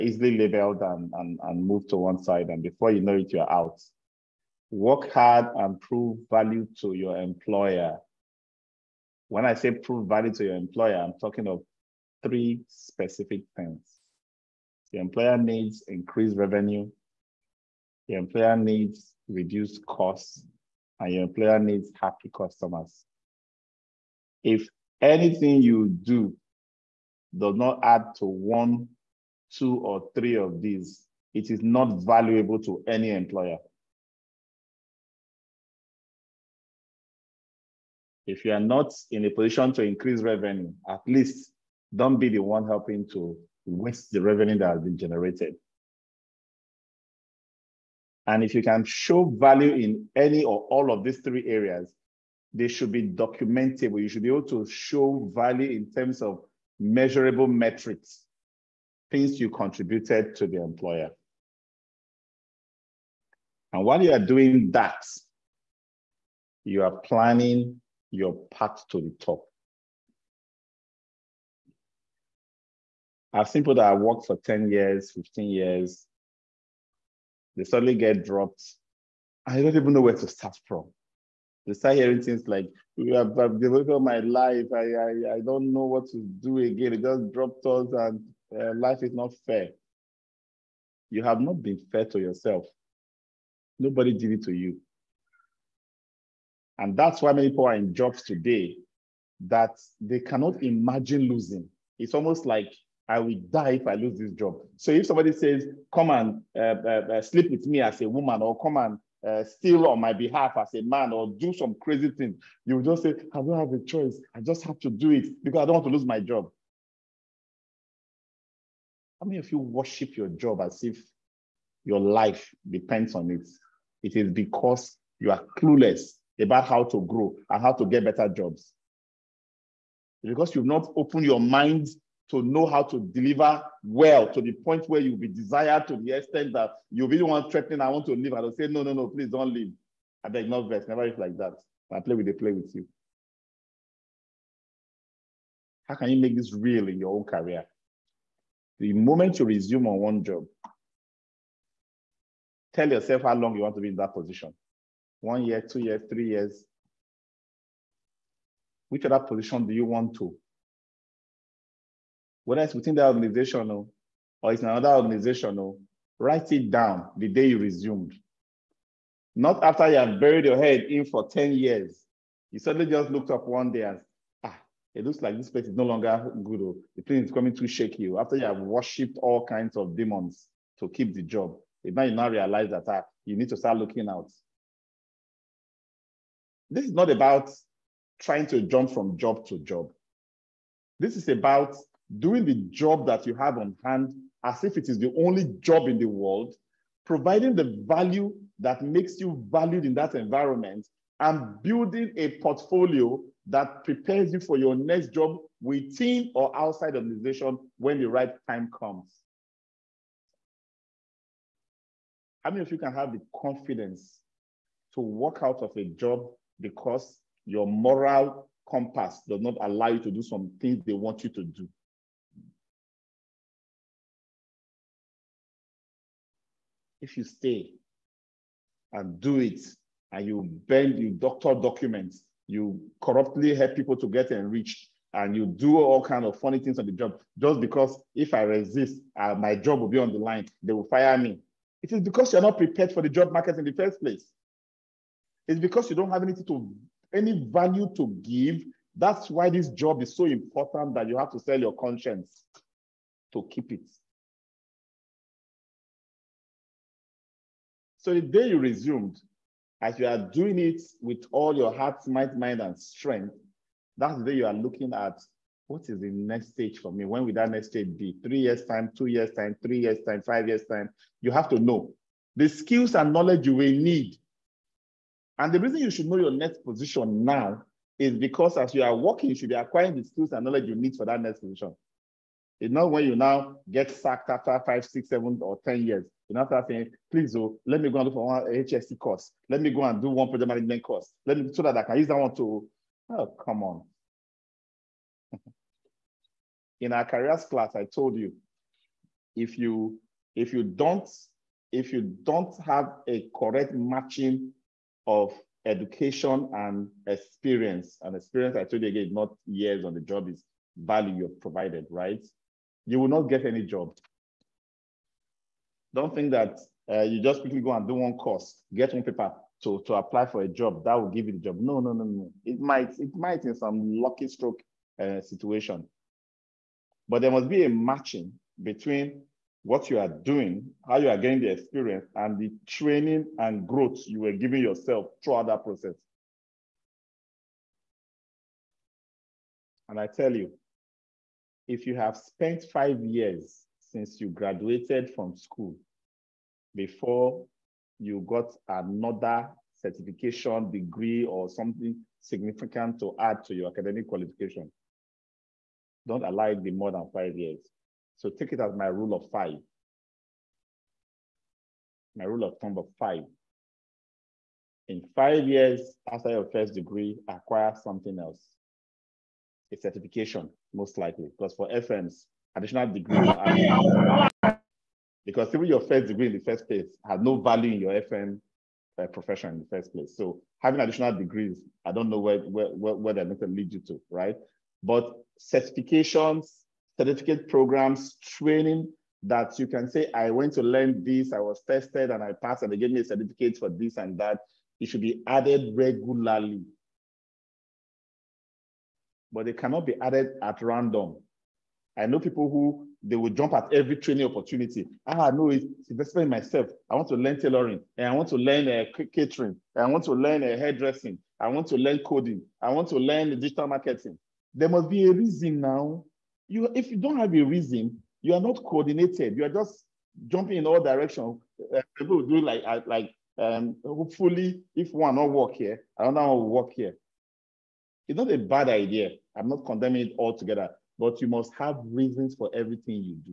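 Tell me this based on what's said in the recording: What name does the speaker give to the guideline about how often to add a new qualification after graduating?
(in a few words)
Rule of five.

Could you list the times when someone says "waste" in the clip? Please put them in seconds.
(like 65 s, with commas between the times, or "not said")
43 s.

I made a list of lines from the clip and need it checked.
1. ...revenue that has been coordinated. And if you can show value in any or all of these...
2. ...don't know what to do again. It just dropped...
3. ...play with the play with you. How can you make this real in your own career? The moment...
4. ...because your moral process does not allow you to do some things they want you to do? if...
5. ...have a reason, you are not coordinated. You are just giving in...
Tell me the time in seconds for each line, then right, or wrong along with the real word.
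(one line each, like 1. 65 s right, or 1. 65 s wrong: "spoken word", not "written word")
1. 44 s wrong: "generated", not "coordinated"
2. 85 s right
3. 141 s right
4. 216 s wrong: "compass", not "process"
5. 417 s wrong: "jumping", not "giving".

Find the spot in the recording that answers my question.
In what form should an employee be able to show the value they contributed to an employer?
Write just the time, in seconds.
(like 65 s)
56 s.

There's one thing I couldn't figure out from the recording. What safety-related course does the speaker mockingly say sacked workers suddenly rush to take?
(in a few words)
HSE course.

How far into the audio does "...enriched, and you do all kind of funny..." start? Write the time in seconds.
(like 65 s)
234 s.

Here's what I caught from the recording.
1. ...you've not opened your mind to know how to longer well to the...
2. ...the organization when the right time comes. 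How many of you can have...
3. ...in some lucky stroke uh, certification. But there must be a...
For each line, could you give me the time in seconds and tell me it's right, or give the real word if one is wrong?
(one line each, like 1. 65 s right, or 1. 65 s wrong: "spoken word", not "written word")
1. 130 s wrong: "deliver", not "longer"
2. 206 s right
3. 323 s wrong: "situation", not "certification".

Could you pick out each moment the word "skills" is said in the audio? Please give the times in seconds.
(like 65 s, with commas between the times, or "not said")
272 s, 280 s.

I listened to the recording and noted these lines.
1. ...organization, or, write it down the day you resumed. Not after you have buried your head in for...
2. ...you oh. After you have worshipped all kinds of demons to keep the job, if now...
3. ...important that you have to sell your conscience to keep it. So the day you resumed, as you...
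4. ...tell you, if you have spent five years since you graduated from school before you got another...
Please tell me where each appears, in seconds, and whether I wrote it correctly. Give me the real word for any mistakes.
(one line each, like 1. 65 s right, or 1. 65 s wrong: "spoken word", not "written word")
1. 164 s right
2. 177 s right
3. 250 s right
4. 340 s right.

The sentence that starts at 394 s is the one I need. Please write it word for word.
It should be added regularly but they cannot be added at random.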